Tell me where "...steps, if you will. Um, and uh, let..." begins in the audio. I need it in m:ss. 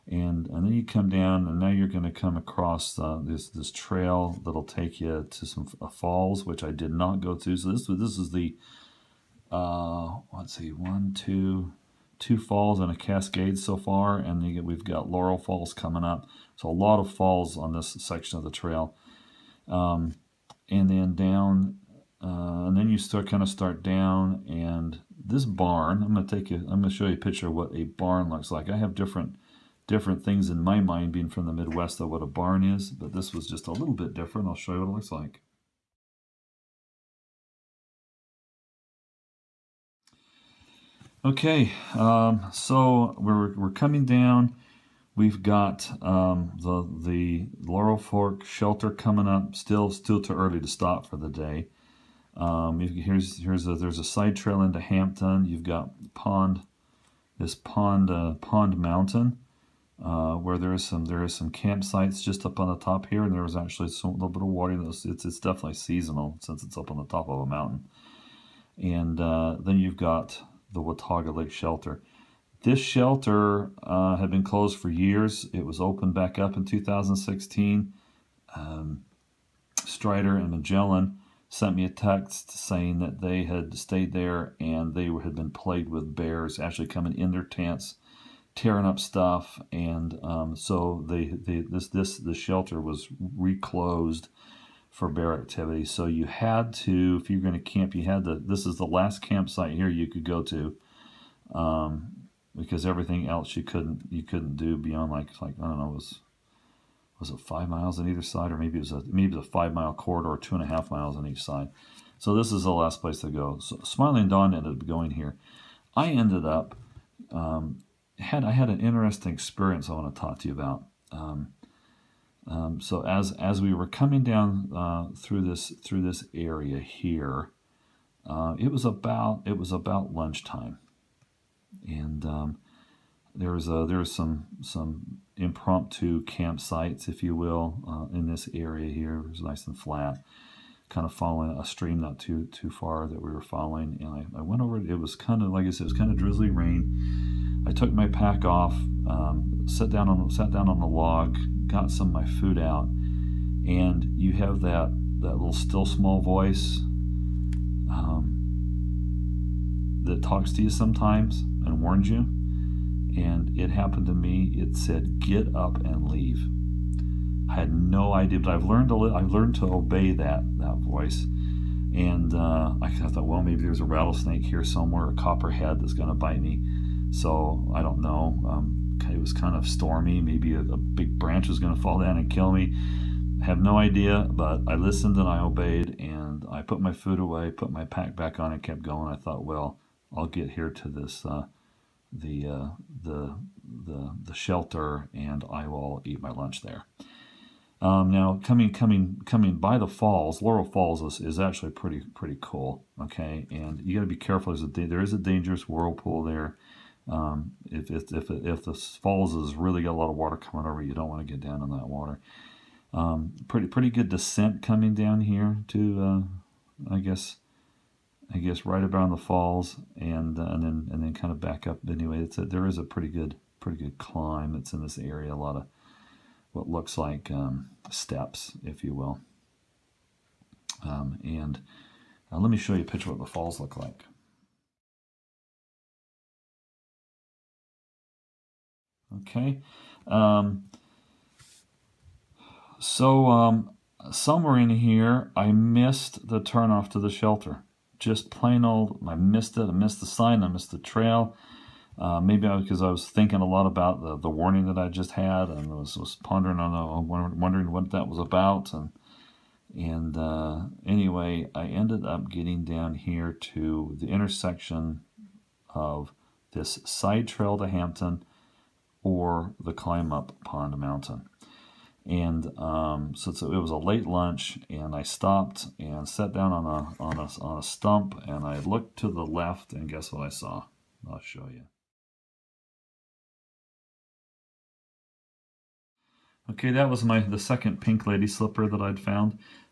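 3:47.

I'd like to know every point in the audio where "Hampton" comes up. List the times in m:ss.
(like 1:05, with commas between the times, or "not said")
0:54, 4:27.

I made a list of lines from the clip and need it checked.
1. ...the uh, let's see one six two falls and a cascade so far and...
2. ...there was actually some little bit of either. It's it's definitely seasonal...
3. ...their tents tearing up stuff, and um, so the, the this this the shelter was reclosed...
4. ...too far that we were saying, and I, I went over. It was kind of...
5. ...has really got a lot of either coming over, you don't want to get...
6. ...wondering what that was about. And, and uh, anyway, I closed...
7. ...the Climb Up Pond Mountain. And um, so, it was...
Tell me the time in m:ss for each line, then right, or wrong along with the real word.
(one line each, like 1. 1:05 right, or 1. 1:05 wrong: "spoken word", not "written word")
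1. 0:08 wrong: "two", not "six"
2. 1:03 wrong: "water", not "either"
3. 1:27 right
4. 2:22 wrong: "following", not "saying"
5. 3:29 wrong: "water", not "either"
6. 4:17 wrong: "ended", not "closed"
7. 4:29 right.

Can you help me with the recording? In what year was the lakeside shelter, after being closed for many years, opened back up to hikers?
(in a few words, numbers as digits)
2016.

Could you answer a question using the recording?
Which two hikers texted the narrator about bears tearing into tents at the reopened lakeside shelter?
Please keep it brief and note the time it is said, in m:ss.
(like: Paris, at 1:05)
Strider and Magellan, at 1:19.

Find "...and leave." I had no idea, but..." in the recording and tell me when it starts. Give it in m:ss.
2:45.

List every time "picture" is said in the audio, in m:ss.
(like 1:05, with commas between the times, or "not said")
0:27, 3:52.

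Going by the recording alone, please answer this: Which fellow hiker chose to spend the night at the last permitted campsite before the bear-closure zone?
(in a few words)
Smiling Dawn.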